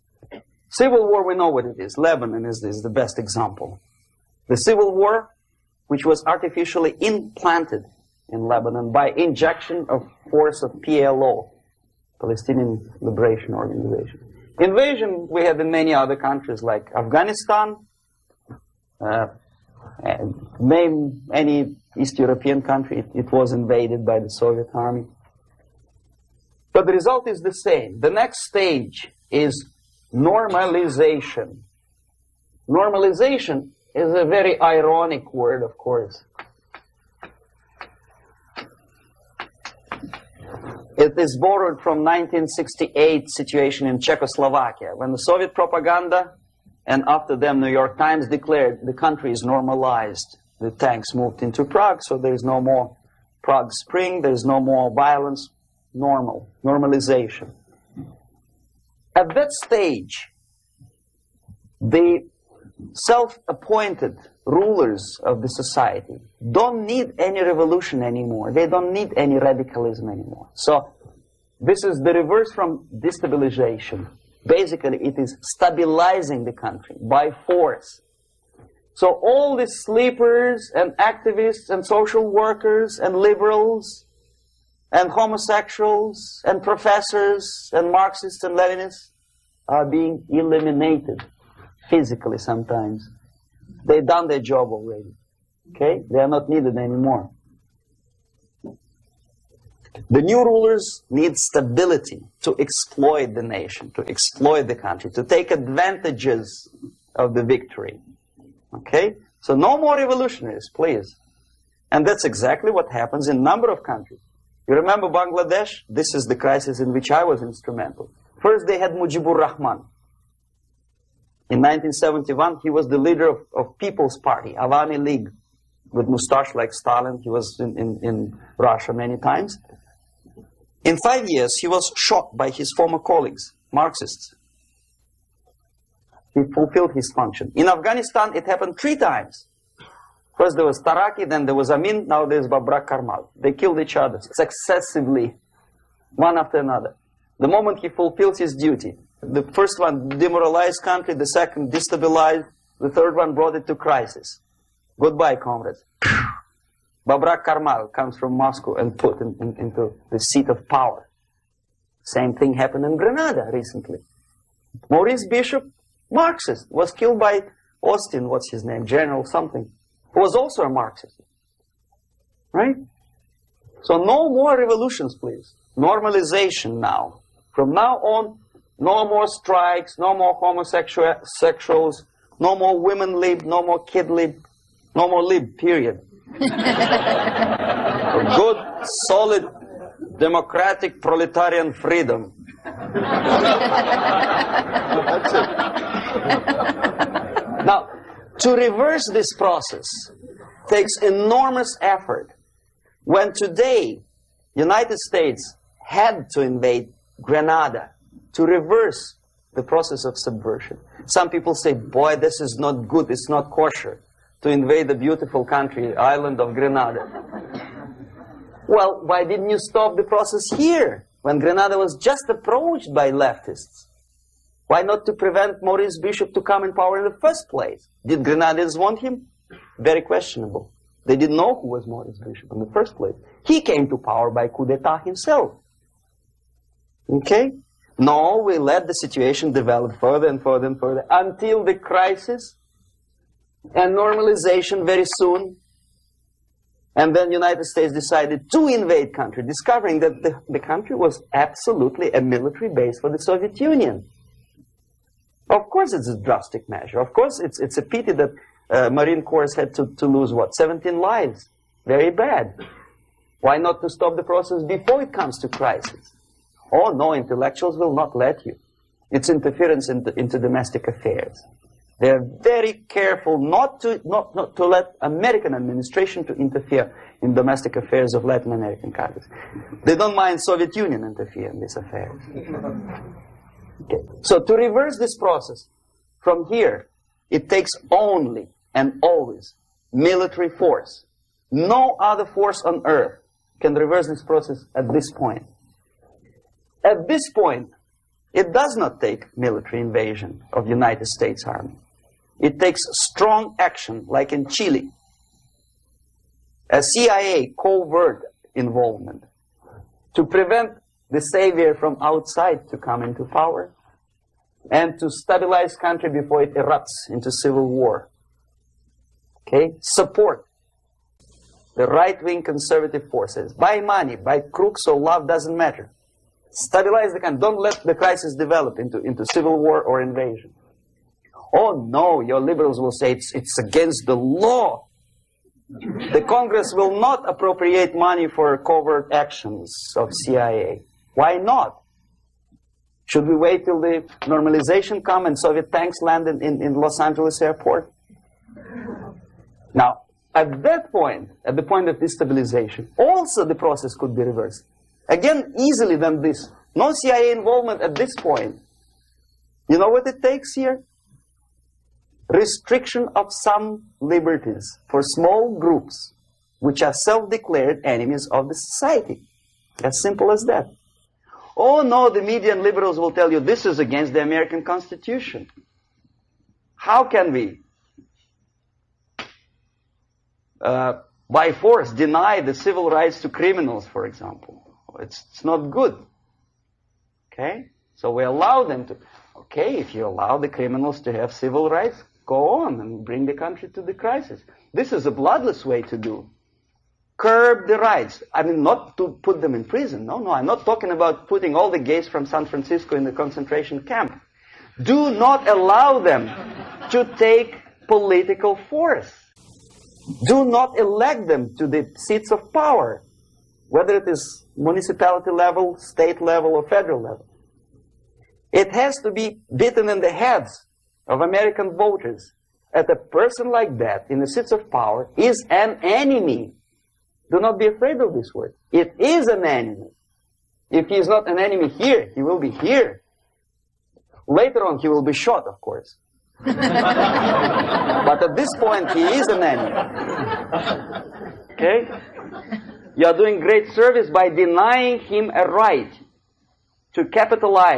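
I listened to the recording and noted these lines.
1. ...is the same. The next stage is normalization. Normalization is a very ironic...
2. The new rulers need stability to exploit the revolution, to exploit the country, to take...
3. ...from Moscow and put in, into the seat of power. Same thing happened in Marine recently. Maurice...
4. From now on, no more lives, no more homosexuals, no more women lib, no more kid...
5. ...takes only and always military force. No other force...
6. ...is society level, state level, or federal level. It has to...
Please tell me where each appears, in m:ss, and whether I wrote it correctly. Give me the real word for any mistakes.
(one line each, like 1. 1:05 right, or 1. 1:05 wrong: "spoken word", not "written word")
1. 0:27 right
2. 1:40 wrong: "nation", not "revolution"
3. 2:38 wrong: "Grenada", not "Marine"
4. 2:57 wrong: "strikes", not "lives"
5. 4:47 right
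6. 6:54 wrong: "municipality", not "society".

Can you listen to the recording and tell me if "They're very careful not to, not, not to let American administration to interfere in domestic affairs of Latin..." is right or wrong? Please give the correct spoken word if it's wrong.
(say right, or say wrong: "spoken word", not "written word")
right.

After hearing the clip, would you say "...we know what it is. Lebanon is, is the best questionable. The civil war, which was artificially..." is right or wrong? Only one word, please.
wrong.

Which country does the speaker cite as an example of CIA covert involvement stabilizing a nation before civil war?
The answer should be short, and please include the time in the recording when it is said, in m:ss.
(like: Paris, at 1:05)
Chile, at 5:04.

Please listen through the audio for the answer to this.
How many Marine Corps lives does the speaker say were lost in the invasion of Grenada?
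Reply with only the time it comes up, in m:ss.
4:20.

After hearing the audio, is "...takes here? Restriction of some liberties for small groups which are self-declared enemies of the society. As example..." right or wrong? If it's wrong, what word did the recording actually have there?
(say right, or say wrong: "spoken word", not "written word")
wrong: "simple", not "example".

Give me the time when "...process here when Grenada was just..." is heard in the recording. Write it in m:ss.
3:40.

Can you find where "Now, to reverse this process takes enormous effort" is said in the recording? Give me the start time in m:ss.
3:17.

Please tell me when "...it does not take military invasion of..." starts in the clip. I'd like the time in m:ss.
4:58.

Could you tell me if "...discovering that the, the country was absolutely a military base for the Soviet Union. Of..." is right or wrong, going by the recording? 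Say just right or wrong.
right.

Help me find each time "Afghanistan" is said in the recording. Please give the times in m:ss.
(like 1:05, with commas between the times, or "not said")
0:16, 2:17.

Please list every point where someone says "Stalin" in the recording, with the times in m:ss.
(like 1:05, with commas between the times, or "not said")
2:06.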